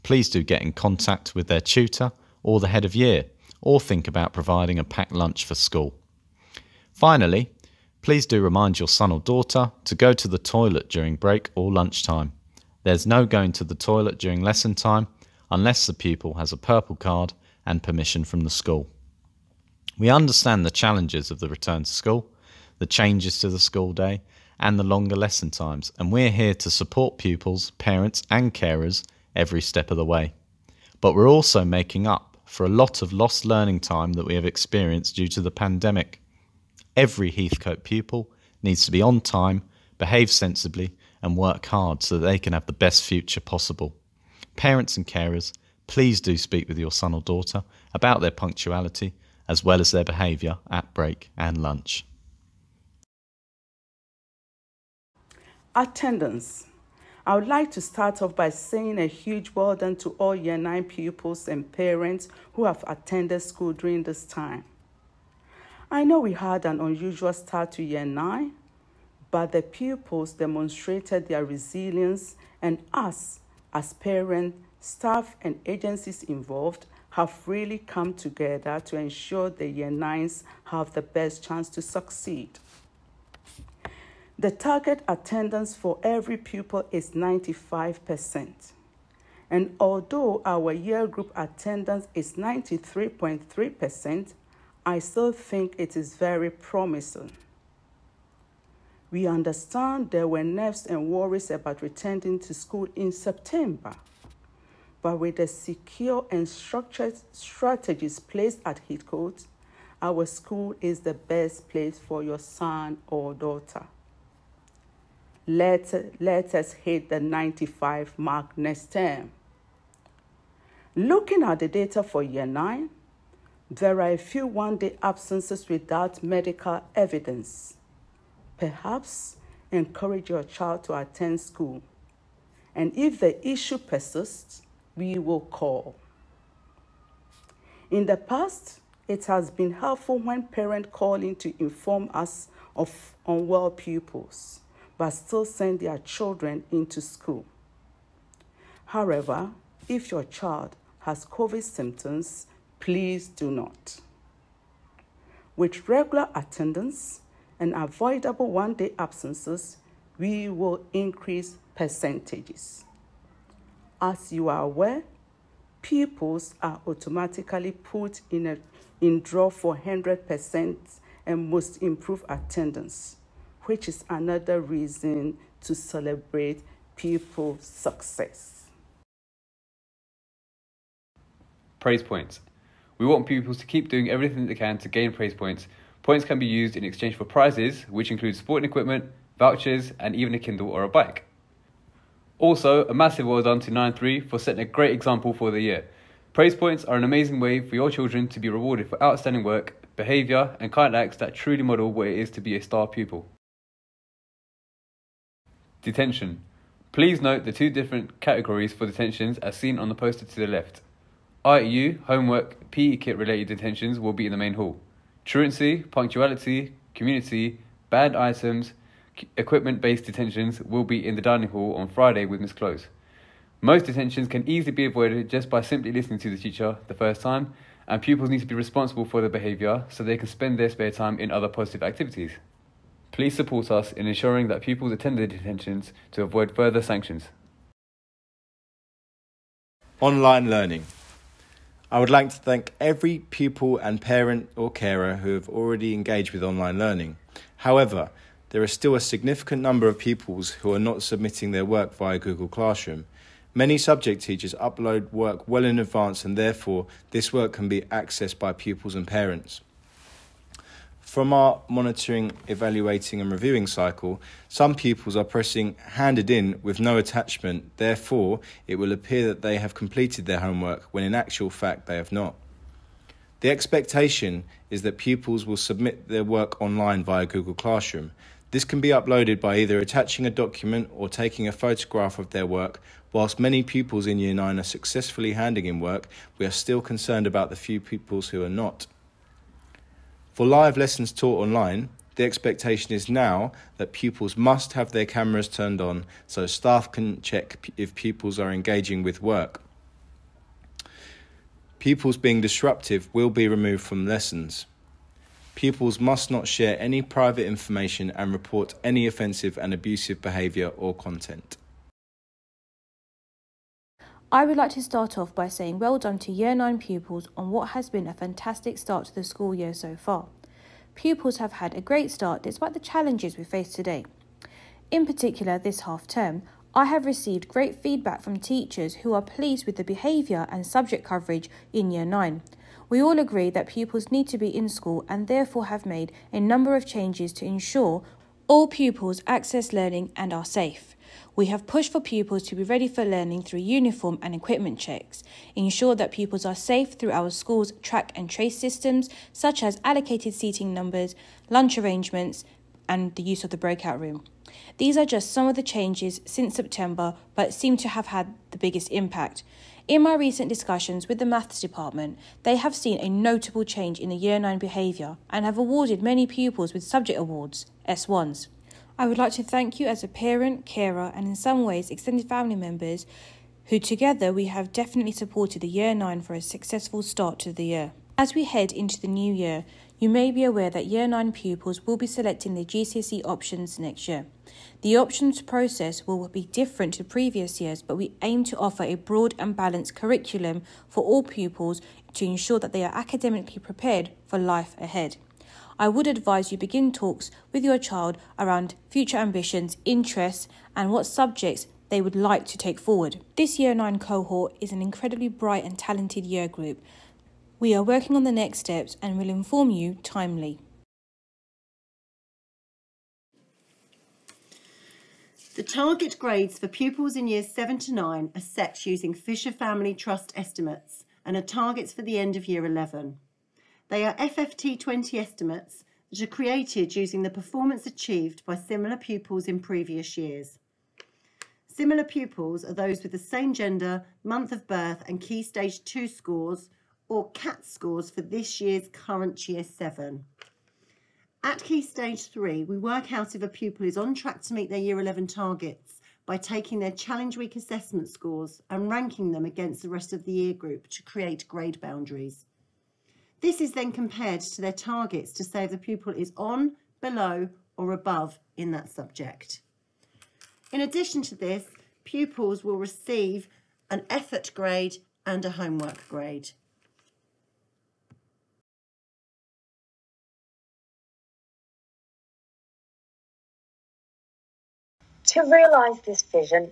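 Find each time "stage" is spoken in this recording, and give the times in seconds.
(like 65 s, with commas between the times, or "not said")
435 s, 441 s.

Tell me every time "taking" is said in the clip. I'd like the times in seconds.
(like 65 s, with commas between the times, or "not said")
281 s, 446 s.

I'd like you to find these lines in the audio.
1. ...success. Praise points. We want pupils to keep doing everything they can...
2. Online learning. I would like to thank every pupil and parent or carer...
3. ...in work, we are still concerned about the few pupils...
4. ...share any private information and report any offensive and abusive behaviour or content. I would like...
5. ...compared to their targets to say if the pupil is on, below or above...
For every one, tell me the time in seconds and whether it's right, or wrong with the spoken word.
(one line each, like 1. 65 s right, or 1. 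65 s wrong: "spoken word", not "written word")
1. 177 s right
2. 239 s right
3. 285 s right
4. 306 s right
5. 453 s right.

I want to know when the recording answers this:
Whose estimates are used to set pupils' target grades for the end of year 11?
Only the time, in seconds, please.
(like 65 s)
419 s.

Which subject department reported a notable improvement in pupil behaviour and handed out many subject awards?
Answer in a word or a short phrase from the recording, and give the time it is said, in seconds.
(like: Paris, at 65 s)
Maths, at 361 s.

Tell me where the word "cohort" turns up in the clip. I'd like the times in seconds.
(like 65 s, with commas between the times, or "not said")
403 s.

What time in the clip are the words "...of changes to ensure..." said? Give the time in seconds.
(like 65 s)
336 s.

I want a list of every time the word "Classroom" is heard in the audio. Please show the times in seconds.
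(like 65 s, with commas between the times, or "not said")
252 s, 277 s.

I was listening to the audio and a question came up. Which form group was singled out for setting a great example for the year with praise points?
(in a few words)
9-3.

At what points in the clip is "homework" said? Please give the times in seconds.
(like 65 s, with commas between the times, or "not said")
212 s, 270 s, 465 s.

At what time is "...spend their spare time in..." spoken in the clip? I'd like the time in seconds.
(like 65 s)
230 s.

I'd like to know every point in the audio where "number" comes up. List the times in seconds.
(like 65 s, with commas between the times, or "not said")
249 s, 336 s, 350 s.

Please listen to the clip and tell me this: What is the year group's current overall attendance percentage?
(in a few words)
93.3%.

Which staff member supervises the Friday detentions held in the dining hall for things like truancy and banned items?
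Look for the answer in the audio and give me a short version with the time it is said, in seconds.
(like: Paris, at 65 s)
Miss Close, at 222 s.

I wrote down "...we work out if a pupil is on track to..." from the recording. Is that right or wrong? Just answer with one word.
right.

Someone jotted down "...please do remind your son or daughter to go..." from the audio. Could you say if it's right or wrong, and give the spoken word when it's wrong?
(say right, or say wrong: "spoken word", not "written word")
right.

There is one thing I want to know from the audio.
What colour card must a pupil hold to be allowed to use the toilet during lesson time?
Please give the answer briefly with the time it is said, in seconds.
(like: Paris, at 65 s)
Purple, at 16 s.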